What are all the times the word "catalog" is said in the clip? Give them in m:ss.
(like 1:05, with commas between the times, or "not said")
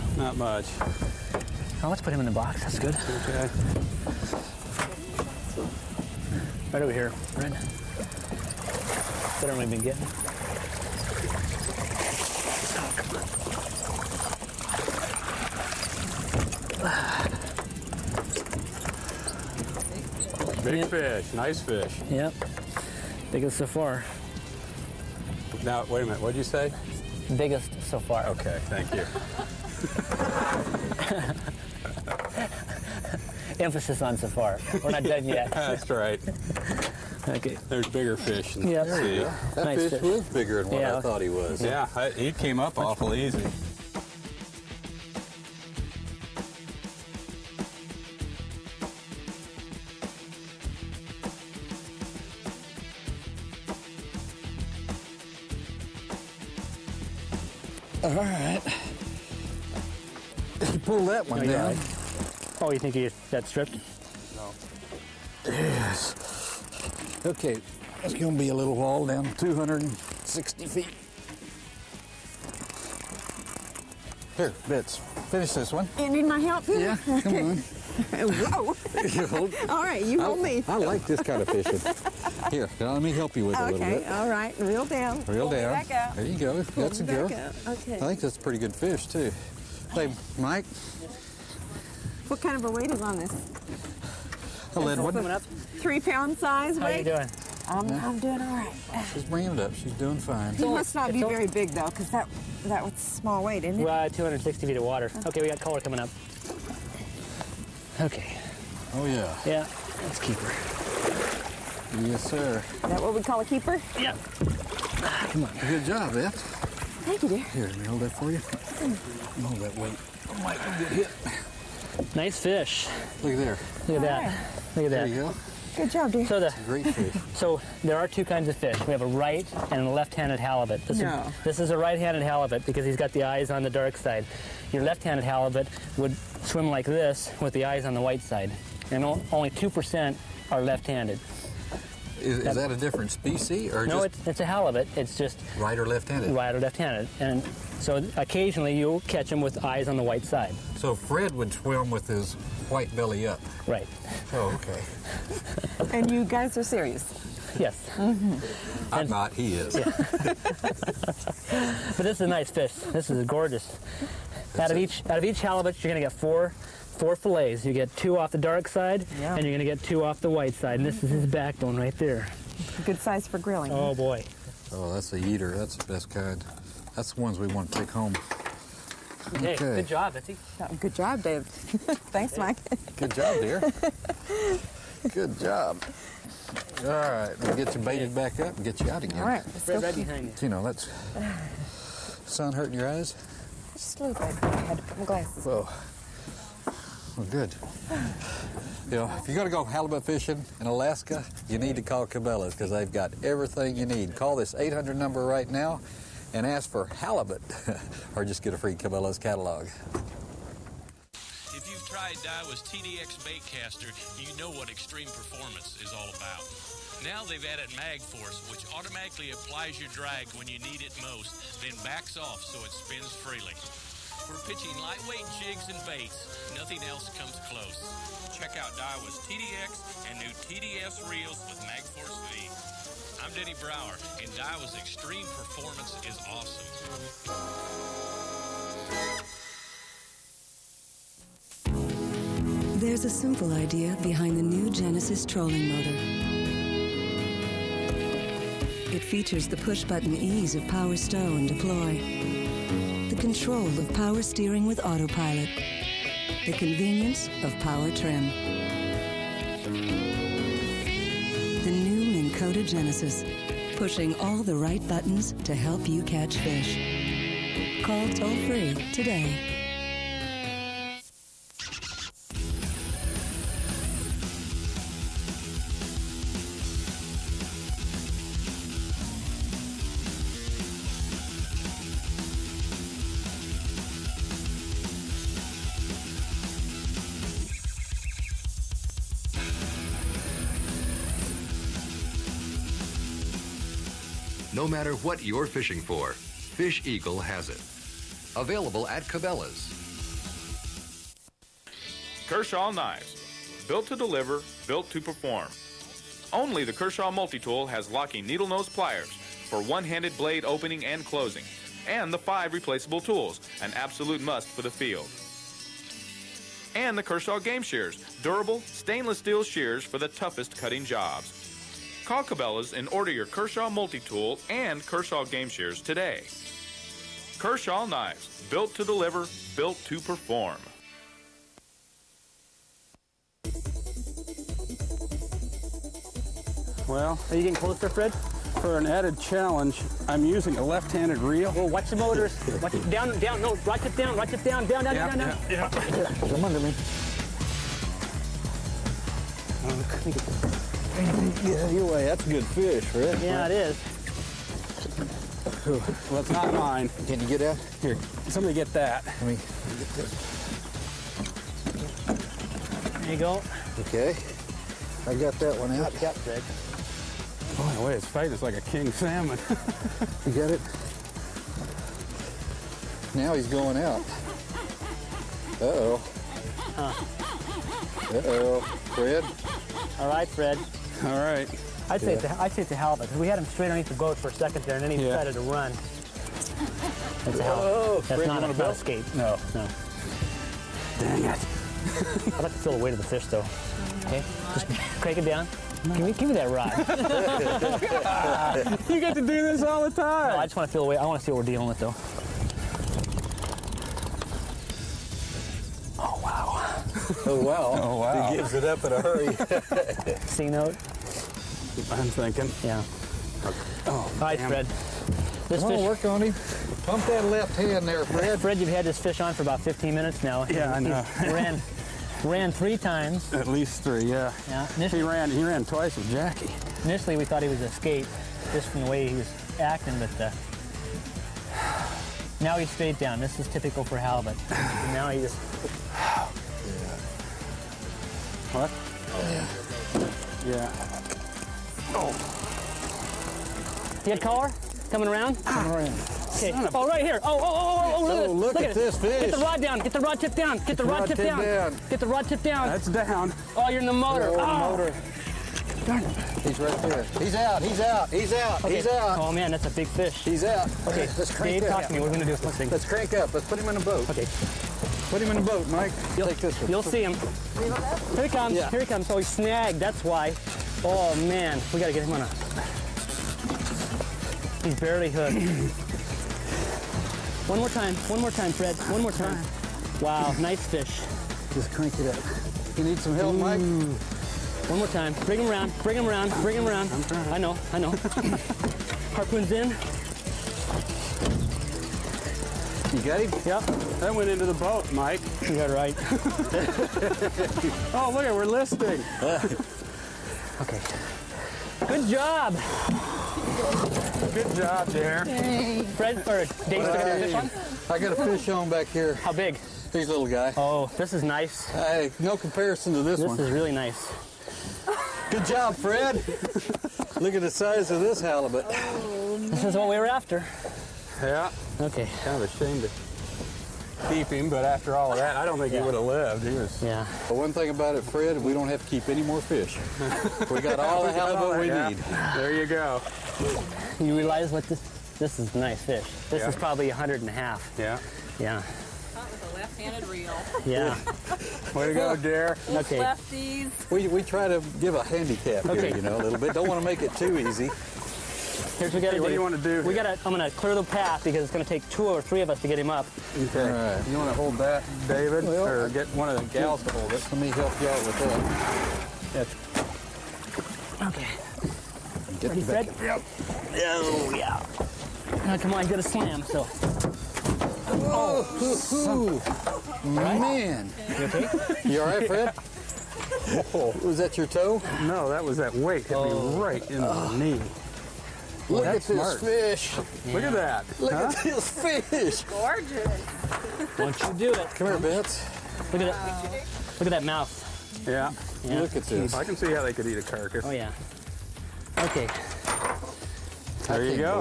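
3:29.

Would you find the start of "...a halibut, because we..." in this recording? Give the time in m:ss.
6:22.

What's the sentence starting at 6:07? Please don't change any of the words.
Boy, the way it's fight is like a king salmon.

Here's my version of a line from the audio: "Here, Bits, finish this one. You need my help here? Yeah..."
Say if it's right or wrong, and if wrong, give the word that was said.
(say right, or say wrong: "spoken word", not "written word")
right.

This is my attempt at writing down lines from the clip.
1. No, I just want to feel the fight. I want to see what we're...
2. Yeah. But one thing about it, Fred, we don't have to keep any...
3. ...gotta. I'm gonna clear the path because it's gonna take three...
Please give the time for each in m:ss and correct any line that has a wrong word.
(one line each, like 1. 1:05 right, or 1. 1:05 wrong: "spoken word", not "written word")
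1. 6:40 wrong: "weight", not "fight"
2. 8:46 right
3. 9:09 wrong: "two", not "three".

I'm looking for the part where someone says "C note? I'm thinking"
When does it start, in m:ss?
6:50.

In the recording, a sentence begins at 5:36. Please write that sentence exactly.
Well, are you getting closer, Fred?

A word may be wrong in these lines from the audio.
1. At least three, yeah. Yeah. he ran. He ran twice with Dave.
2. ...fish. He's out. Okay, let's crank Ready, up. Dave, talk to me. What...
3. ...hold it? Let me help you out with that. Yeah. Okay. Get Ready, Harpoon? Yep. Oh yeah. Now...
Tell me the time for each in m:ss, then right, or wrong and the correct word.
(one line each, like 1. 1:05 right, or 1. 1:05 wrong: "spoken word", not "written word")
1. 7:03 wrong: "Jackie", not "Dave"
2. 7:39 wrong: "Dave", not "Ready"
3. 9:16 wrong: "Fred", not "Harpoon".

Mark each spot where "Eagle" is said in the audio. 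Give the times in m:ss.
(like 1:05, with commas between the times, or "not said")
4:56.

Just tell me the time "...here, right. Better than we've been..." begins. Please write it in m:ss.
0:06.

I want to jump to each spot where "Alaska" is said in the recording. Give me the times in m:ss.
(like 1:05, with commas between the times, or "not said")
3:20.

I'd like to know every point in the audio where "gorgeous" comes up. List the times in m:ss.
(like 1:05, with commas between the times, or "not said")
2:43, 9:42.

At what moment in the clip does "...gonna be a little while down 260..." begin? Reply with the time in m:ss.
1:08.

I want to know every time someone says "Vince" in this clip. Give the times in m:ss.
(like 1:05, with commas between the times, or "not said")
9:44.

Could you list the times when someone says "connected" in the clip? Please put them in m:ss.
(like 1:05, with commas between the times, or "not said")
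not said.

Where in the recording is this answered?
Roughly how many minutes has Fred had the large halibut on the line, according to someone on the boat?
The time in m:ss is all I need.
6:59.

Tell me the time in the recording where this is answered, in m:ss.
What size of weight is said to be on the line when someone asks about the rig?
1:35.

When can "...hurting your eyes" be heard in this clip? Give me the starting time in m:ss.
3:12.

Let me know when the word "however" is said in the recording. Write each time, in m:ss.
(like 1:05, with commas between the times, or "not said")
not said.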